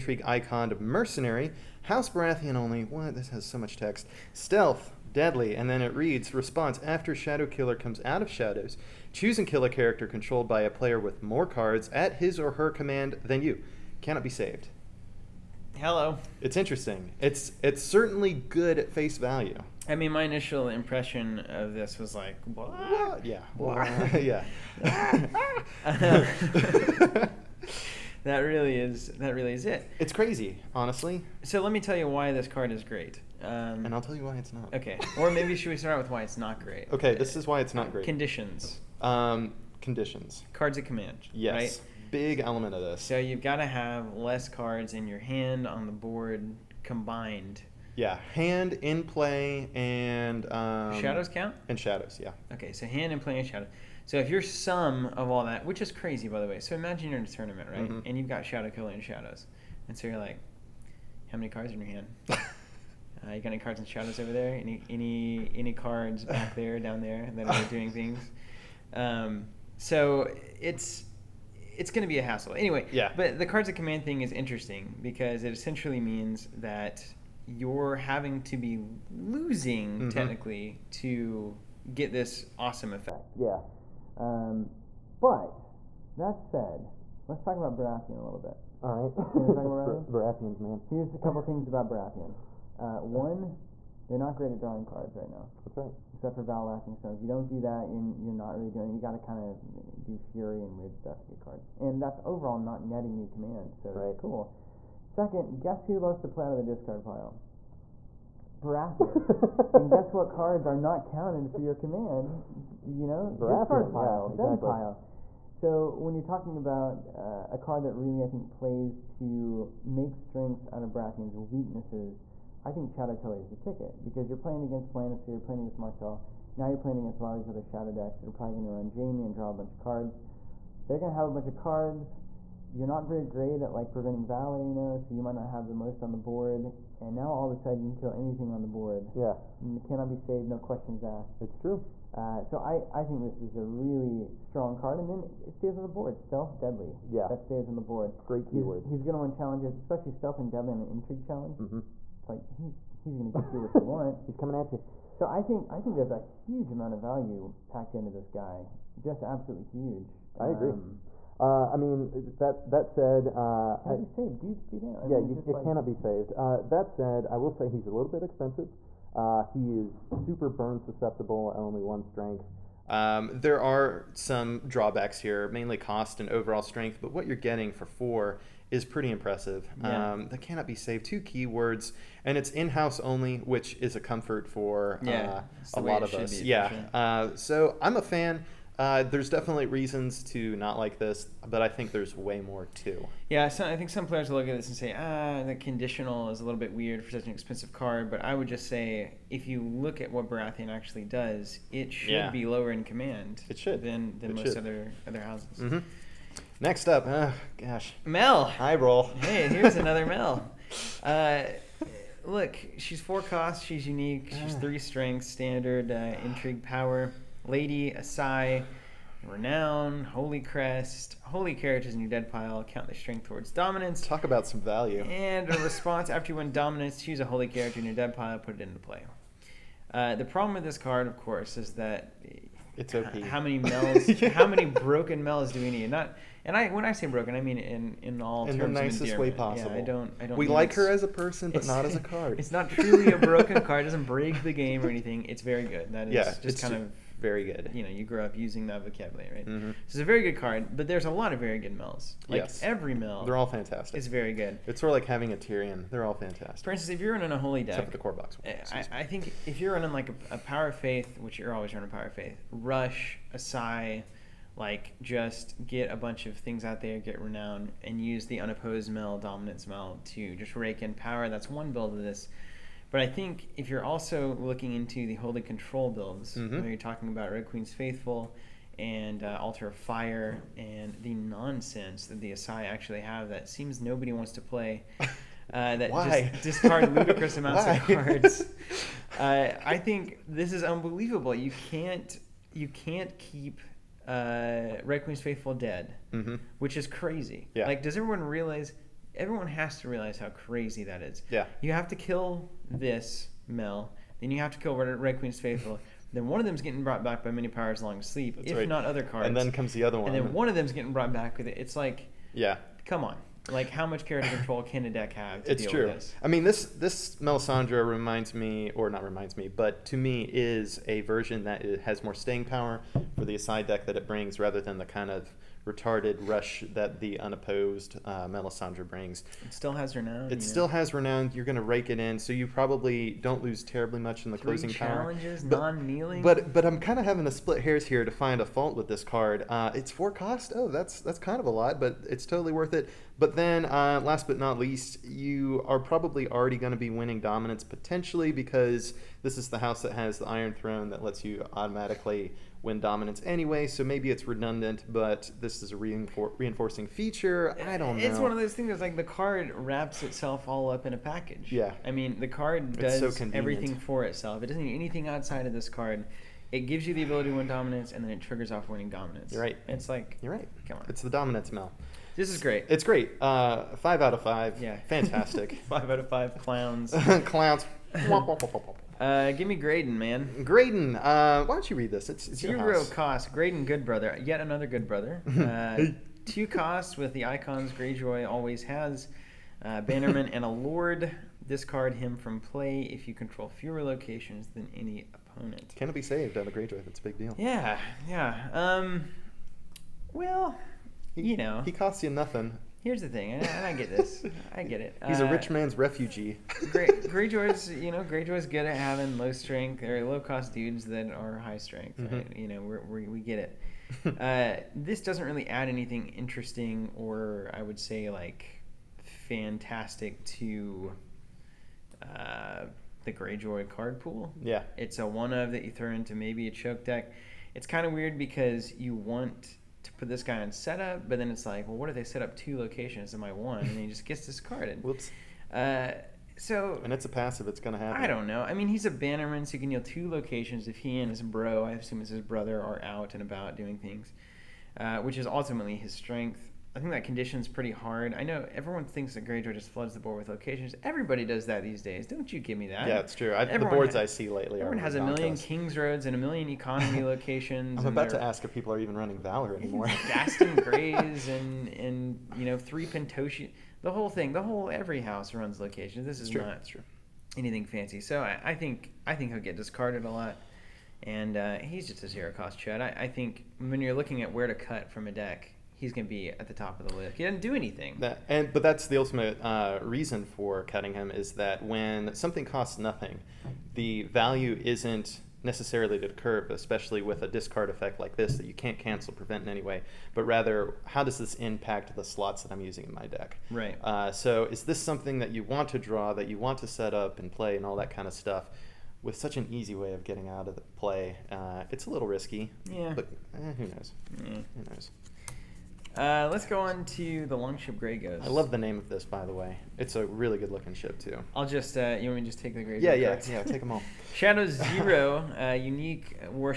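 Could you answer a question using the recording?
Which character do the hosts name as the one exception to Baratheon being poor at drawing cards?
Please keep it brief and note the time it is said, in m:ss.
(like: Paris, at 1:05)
Val Laughing Storm, at 1:36.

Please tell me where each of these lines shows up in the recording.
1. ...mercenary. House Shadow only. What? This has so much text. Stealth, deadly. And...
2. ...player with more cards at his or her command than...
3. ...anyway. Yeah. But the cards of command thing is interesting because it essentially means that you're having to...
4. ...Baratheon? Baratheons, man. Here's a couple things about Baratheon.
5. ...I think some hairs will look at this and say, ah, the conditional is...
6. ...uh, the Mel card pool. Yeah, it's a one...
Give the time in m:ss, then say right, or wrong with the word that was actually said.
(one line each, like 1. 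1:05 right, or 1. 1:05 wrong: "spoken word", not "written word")
1. 0:00 wrong: "Baratheon", not "Shadow"
2. 0:10 right
3. 1:12 right
4. 1:30 right
5. 3:13 wrong: "players", not "hairs"
6. 7:02 wrong: "Greyjoy", not "Mel".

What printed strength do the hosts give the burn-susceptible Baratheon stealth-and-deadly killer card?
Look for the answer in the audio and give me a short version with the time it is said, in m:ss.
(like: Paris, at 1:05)
1, at 2:51.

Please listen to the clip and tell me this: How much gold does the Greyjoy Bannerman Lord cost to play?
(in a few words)
2.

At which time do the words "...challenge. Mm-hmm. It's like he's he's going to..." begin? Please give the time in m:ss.
2:31.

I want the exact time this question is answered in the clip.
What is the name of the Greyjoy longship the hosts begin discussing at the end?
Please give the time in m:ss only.
8:27.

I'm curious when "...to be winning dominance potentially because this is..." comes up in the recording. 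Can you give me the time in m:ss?
5:46.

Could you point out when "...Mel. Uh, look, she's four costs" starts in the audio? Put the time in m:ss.
3:30.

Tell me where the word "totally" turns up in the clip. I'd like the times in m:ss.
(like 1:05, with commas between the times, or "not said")
5:42.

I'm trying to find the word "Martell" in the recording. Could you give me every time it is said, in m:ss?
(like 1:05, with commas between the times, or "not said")
2:05.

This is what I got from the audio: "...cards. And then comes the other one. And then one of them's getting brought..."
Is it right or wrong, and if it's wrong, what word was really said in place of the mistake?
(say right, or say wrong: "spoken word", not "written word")
right.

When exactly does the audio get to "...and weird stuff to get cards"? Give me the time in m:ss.
1:40.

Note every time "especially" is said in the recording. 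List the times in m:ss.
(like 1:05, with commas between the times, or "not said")
2:29, 8:06.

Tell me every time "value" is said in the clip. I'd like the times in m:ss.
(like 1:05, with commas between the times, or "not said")
0:19, 2:36, 3:44, 8:04.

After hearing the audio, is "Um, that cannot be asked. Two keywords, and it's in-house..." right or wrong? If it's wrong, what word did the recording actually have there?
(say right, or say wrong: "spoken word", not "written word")
wrong: "saved", not "asked".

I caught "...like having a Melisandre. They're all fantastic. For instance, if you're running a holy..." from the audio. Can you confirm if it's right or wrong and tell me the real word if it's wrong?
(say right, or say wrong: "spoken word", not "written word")
wrong: "Tyrion", not "Melisandre".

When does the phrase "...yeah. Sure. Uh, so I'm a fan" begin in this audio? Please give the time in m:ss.
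3:06.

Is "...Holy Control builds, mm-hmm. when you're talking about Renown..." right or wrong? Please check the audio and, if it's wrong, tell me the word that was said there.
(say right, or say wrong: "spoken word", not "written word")
wrong: "Red", not "Renown".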